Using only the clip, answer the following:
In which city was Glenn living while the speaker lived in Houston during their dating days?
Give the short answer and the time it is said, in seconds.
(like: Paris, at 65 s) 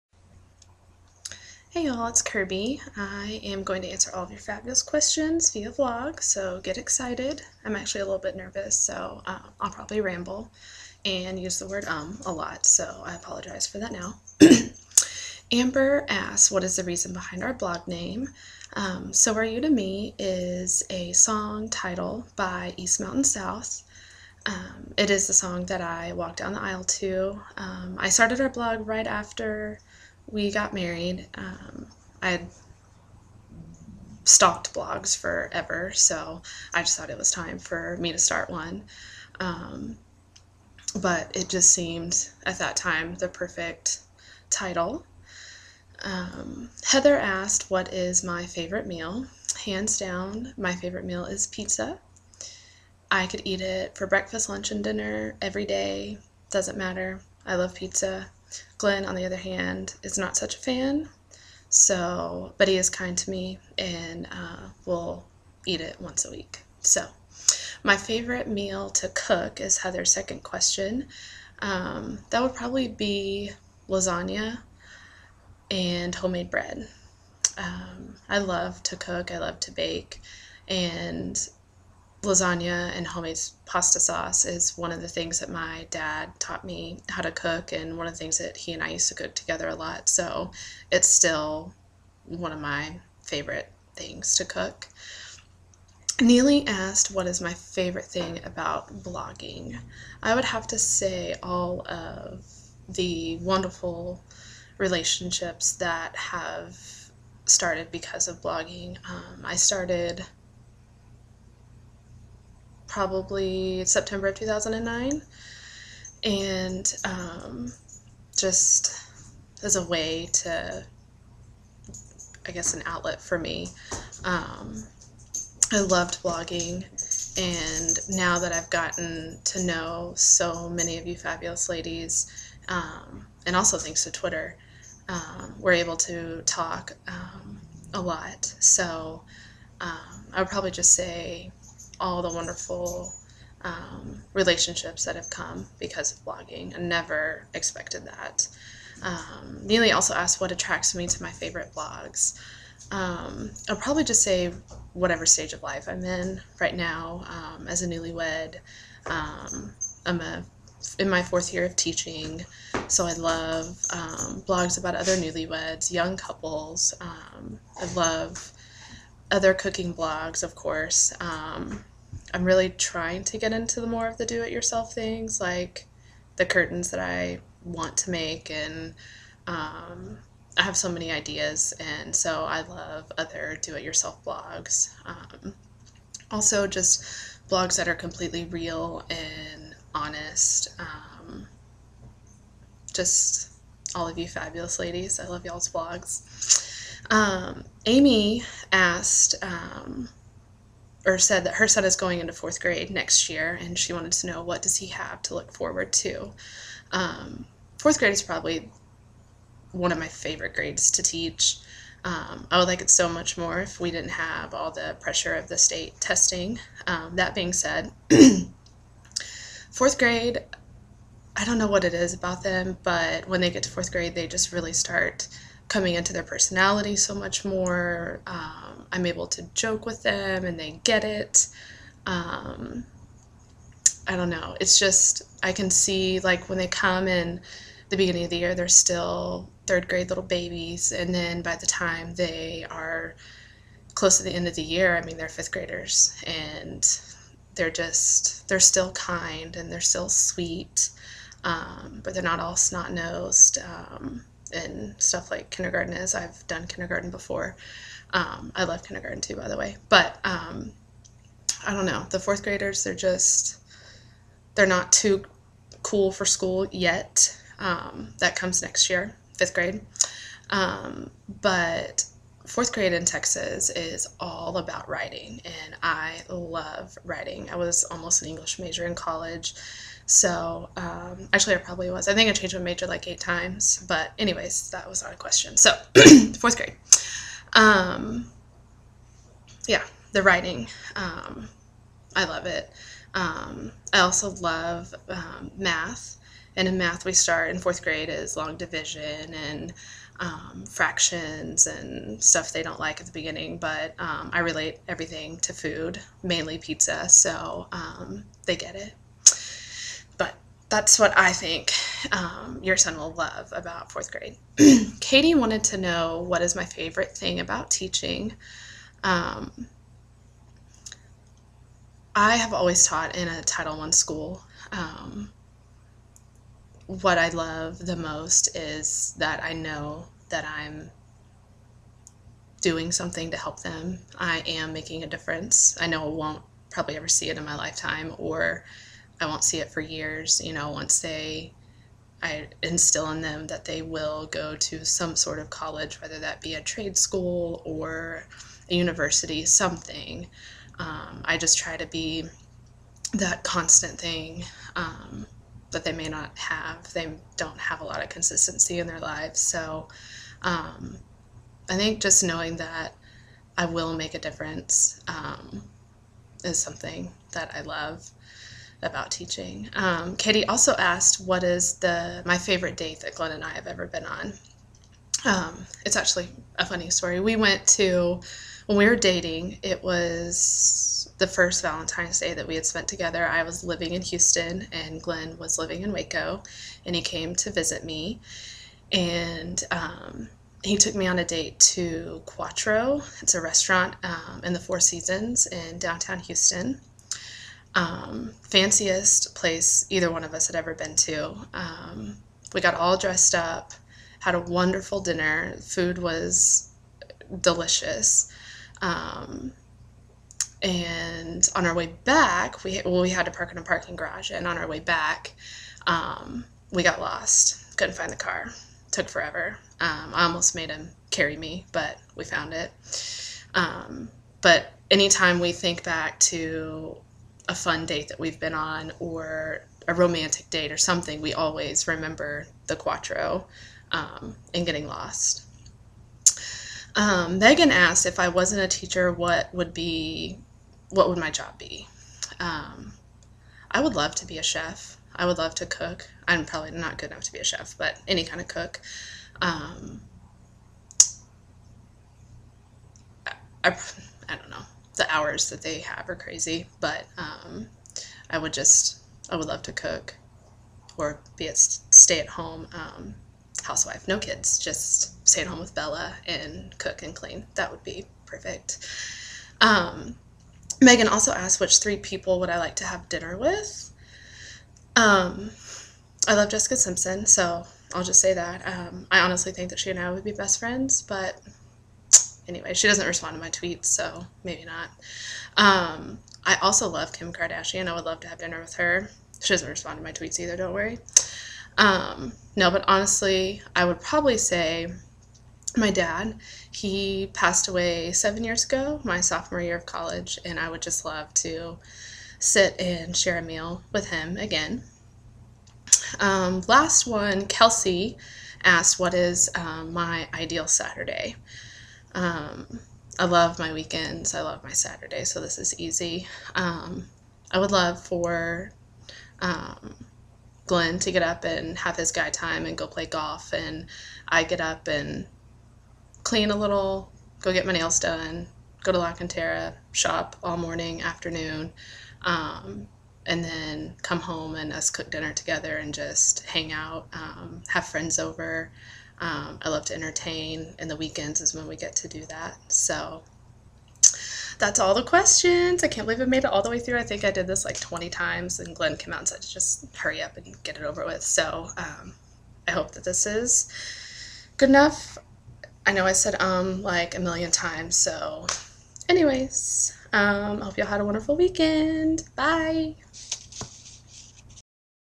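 Waco, at 385 s.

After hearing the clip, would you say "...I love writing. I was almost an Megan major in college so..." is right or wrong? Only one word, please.
wrong.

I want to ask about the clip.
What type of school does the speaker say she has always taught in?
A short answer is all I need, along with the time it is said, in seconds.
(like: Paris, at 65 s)
Title I school, at 323 s.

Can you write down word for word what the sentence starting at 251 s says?
Um, but they're not all snot nosed.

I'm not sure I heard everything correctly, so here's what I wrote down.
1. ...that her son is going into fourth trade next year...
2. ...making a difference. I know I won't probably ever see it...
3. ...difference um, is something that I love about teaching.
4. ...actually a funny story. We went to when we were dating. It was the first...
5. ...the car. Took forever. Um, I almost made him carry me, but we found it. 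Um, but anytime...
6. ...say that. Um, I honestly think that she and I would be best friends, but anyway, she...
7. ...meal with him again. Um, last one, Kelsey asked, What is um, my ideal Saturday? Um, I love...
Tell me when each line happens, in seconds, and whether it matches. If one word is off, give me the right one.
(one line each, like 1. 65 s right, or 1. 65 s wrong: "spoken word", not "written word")
1. 201 s wrong: "grade", not "trade"
2. 334 s right
3. 364 s right
4. 375 s right
5. 418 s right
6. 478 s right
7. 503 s right.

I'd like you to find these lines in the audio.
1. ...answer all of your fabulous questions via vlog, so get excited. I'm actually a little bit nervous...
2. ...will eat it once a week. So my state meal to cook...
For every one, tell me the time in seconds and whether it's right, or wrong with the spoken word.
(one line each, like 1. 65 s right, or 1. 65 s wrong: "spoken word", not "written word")
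1. 3 s right
2. 64 s wrong: "favorite", not "state".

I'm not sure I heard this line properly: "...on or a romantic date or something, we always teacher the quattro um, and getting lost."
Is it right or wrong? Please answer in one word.
wrong.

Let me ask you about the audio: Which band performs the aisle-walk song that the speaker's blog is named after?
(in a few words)
East Mountain South.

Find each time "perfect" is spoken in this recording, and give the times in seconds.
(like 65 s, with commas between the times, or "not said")
43 s, 468 s.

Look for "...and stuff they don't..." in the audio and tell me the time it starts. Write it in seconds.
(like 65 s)
301 s.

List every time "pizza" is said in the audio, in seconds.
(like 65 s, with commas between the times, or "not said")
51 s, 57 s, 306 s.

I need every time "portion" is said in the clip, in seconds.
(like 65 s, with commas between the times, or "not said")
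not said.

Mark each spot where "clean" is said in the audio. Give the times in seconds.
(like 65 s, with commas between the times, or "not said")
467 s, 526 s.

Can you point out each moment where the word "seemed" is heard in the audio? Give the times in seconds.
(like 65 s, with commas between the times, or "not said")
41 s.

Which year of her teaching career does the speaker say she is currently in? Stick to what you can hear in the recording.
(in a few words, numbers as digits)
Fourth year.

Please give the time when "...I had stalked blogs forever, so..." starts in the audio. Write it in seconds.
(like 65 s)
32 s.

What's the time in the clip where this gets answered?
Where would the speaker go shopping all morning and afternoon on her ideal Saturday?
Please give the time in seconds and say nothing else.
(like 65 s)
528 s.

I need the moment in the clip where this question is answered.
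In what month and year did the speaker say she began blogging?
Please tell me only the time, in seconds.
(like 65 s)
113 s.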